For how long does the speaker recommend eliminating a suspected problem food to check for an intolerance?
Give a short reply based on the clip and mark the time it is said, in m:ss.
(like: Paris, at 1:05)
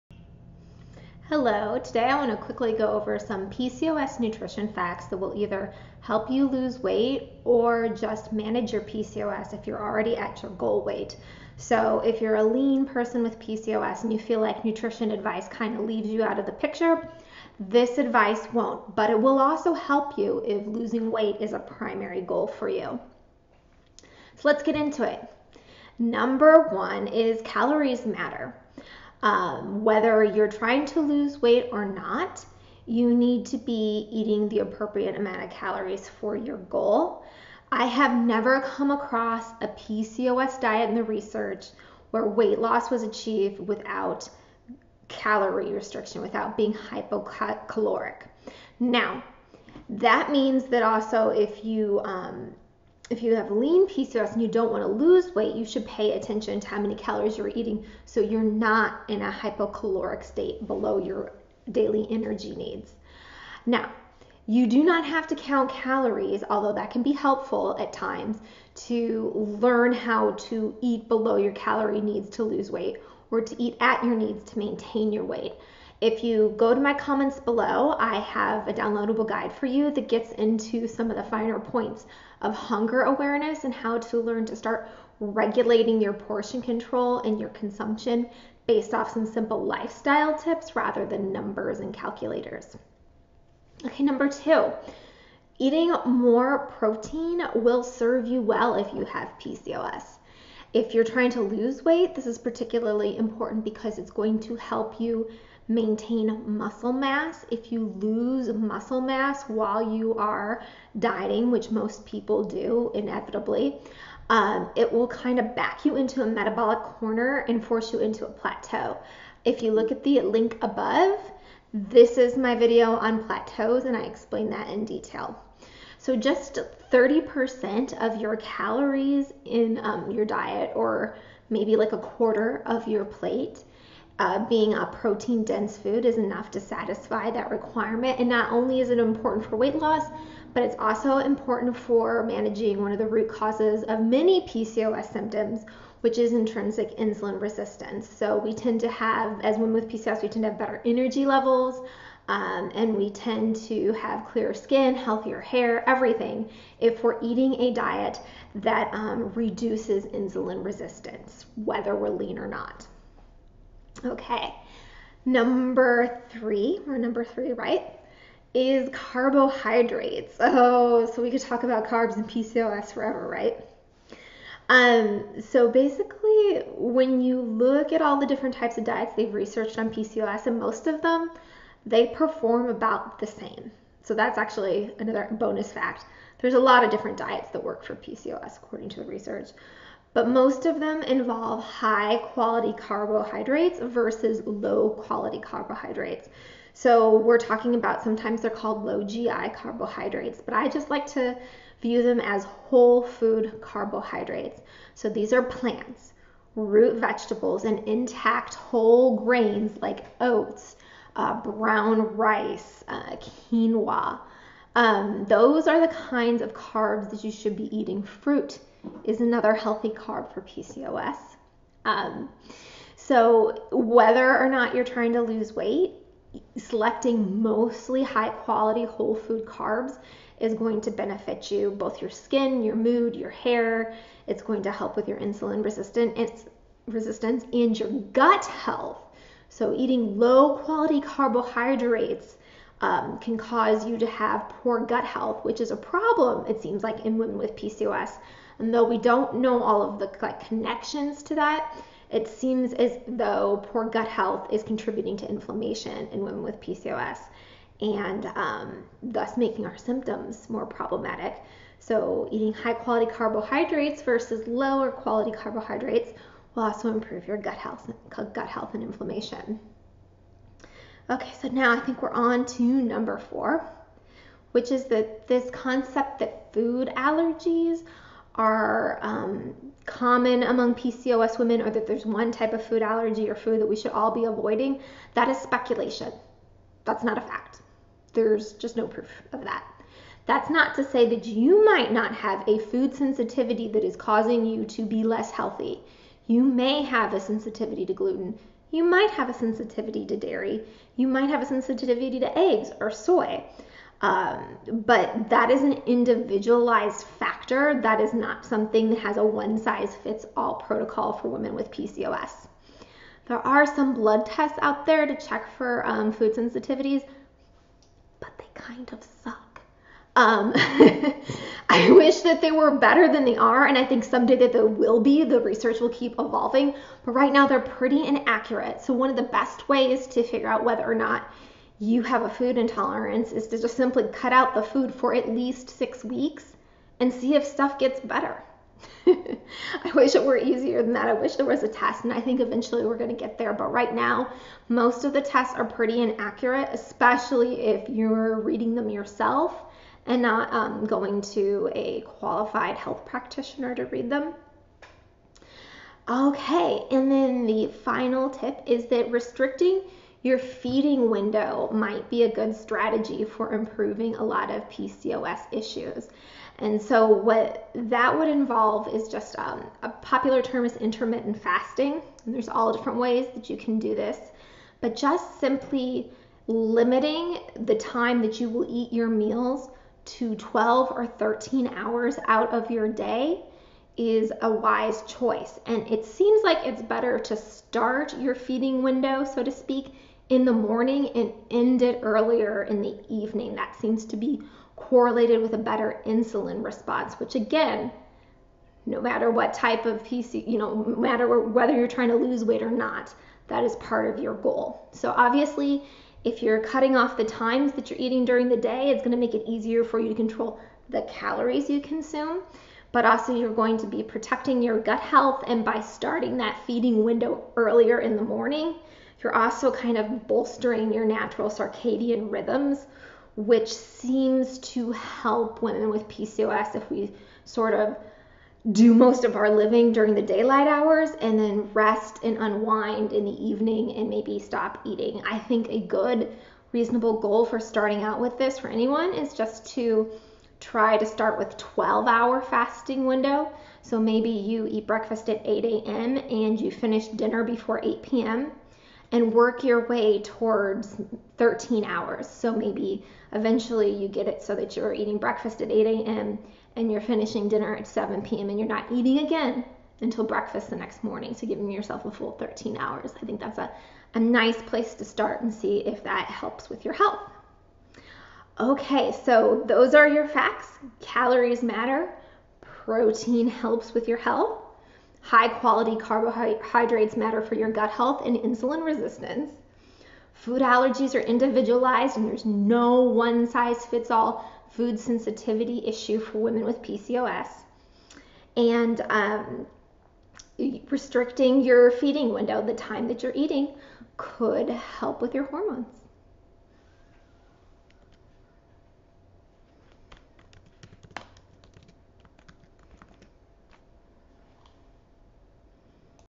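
6 weeks, at 5:35.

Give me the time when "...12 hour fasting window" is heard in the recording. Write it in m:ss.
7:21.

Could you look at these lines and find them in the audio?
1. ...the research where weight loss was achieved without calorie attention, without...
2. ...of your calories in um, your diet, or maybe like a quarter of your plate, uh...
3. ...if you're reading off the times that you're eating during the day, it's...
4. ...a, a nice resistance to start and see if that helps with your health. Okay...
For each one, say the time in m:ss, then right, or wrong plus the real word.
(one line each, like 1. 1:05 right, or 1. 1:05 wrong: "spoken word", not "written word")
1. 0:40 wrong: "restriction", not "attention"
2. 2:08 right
3. 6:46 wrong: "cutting", not "reading"
4. 7:43 wrong: "place", not "resistance".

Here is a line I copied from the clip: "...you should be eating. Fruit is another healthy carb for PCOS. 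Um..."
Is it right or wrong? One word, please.
right.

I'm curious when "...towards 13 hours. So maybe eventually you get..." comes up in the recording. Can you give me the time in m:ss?
7:30.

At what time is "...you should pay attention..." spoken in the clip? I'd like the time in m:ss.
0:55.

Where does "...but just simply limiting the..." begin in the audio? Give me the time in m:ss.
6:14.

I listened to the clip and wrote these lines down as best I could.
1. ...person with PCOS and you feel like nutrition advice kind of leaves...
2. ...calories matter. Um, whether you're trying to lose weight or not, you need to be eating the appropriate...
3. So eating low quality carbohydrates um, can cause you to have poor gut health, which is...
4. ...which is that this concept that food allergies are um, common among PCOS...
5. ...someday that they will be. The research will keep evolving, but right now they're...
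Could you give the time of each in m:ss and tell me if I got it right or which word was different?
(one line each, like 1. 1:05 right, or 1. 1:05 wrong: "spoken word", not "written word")
1. 0:12 right
2. 0:27 right
3. 3:59 right
4. 4:34 right
5. 5:24 right.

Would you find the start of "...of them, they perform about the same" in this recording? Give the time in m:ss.
3:00.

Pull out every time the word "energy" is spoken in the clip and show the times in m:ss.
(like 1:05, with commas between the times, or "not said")
1:02, 2:30.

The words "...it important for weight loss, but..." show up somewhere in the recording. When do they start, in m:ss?
2:18.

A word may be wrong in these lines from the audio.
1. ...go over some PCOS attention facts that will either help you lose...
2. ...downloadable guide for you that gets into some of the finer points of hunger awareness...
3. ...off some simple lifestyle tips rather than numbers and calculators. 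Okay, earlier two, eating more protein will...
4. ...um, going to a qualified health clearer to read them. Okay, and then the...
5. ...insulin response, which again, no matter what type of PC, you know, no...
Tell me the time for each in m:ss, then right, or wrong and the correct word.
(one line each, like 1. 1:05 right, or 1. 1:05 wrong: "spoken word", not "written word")
1. 0:02 wrong: "nutrition", not "attention"
2. 1:18 right
3. 1:28 wrong: "number", not "earlier"
4. 5:50 wrong: "practitioner", not "clearer"
5. 6:36 right.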